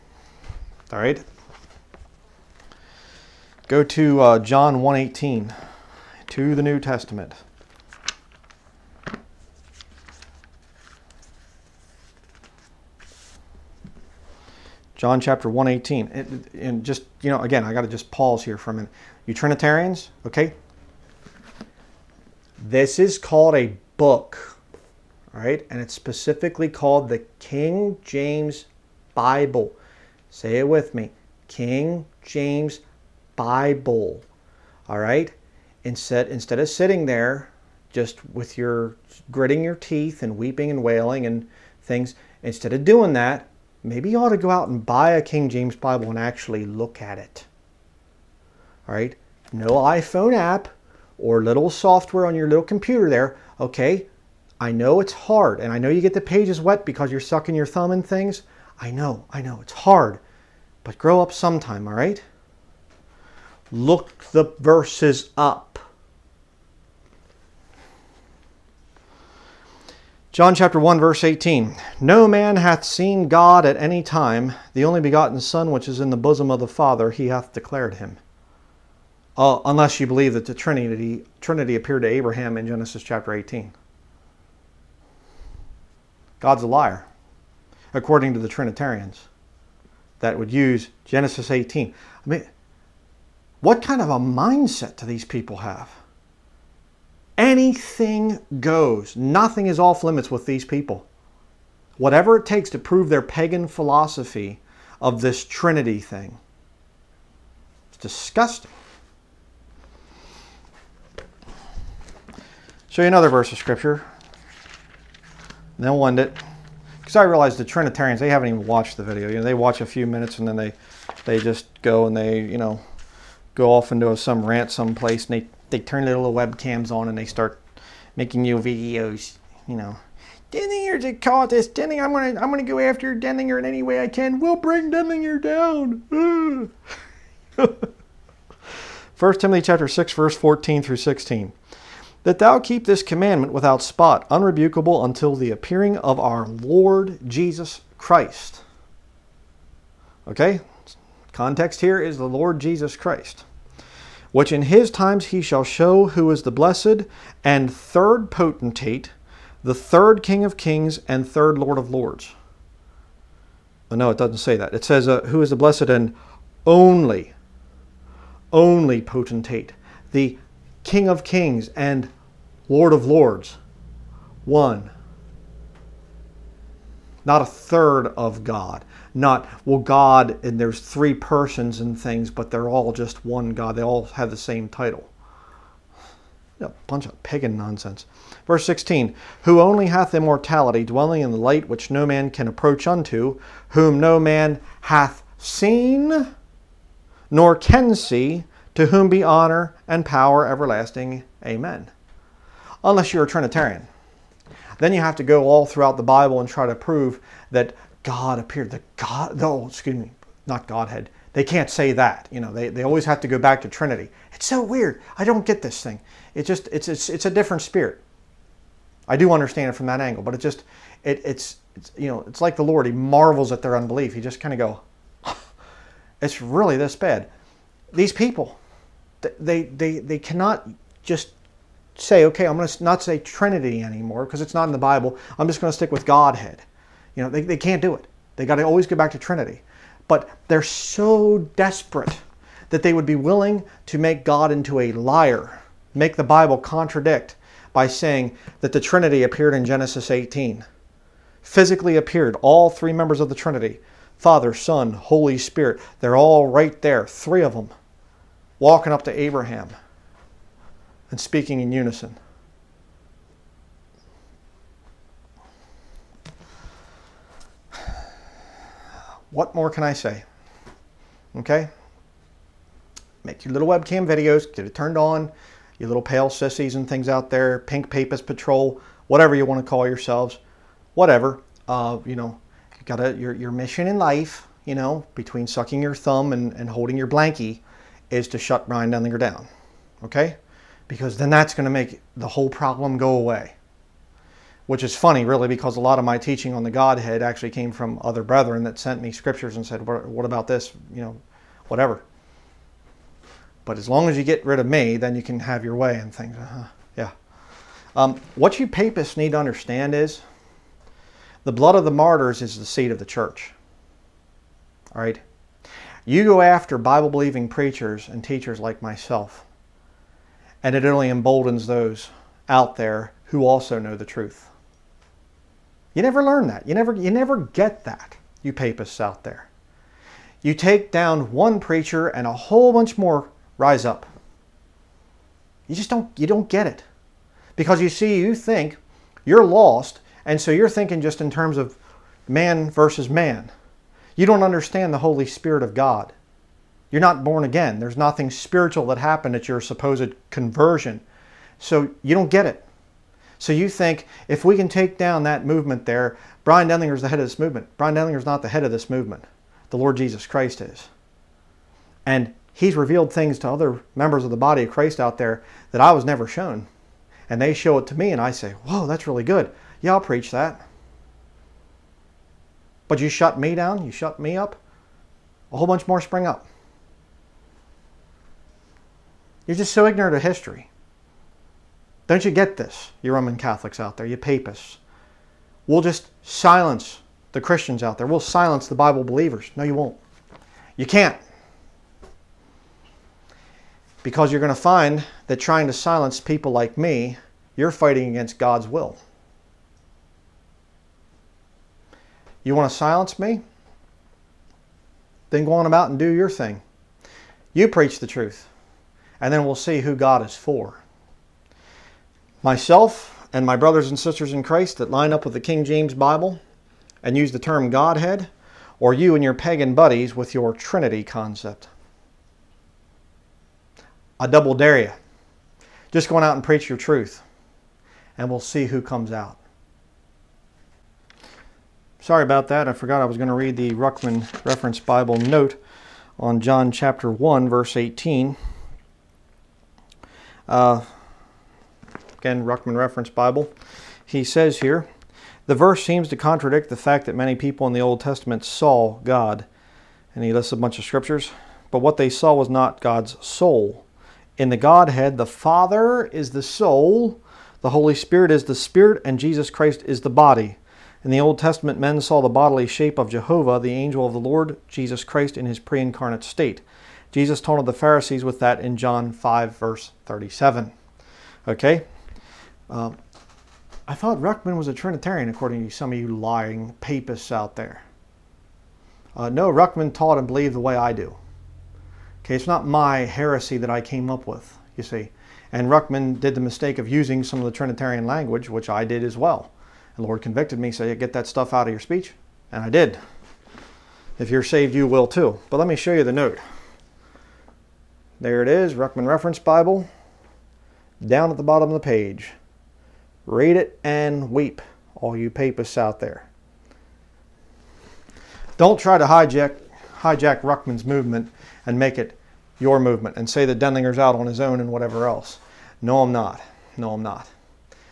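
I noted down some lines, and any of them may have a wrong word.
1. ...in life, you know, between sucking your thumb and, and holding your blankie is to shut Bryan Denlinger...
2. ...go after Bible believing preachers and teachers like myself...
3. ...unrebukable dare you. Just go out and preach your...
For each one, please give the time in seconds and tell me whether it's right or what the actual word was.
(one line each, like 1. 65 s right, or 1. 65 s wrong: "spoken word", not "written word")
1. 283 s right
2. 316 s right
3. 424 s wrong: "double", not "unrebukable".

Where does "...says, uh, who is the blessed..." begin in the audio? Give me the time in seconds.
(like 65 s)
164 s.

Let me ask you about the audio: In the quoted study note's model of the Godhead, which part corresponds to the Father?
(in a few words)
the soul.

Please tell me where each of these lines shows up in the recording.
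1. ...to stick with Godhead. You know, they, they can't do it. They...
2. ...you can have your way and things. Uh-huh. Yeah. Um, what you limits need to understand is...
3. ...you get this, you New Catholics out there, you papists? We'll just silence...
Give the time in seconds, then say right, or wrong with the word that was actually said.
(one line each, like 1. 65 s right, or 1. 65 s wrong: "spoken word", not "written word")
1. 235 s right
2. 305 s wrong: "papists", not "limits"
3. 382 s wrong: "Roman", not "New".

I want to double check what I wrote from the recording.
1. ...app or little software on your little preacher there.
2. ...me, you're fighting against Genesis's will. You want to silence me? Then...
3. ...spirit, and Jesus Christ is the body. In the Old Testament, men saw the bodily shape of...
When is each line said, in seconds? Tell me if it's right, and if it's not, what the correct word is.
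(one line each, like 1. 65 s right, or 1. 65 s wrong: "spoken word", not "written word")
1. 50 s wrong: "computer", not "preacher"
2. 396 s wrong: "God", not "Genesis"
3. 458 s right.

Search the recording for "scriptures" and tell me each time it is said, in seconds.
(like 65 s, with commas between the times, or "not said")
113 s, 299 s, 450 s.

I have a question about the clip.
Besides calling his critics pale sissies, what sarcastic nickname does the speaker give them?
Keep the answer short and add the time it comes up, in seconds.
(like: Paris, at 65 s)
pink papist patrol, at 277 s.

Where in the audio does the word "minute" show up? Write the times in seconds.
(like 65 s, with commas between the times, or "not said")
18 s, 120 s.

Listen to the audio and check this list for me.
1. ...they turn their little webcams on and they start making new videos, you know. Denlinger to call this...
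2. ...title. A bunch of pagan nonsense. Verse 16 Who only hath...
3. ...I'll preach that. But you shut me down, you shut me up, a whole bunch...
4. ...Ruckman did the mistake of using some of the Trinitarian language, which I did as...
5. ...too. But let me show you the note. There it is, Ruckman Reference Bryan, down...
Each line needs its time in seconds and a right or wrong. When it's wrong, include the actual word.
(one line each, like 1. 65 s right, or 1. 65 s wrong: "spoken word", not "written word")
1. 125 s right
2. 184 s right
3. 369 s right
4. 485 s right
5. 495 s wrong: "Bible", not "Bryan".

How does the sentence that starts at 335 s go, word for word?
You just don't, you don't get it.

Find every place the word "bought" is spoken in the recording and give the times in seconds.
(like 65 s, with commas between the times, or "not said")
not said.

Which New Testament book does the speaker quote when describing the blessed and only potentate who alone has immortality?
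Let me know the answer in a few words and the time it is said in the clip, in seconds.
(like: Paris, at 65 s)
First Timothy, at 139 s.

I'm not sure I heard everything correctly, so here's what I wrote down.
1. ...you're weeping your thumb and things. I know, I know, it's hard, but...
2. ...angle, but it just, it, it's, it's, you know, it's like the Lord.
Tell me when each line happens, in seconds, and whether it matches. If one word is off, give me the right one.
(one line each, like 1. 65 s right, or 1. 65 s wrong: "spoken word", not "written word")
1. 57 s wrong: "sucking", not "weeping"
2. 220 s right.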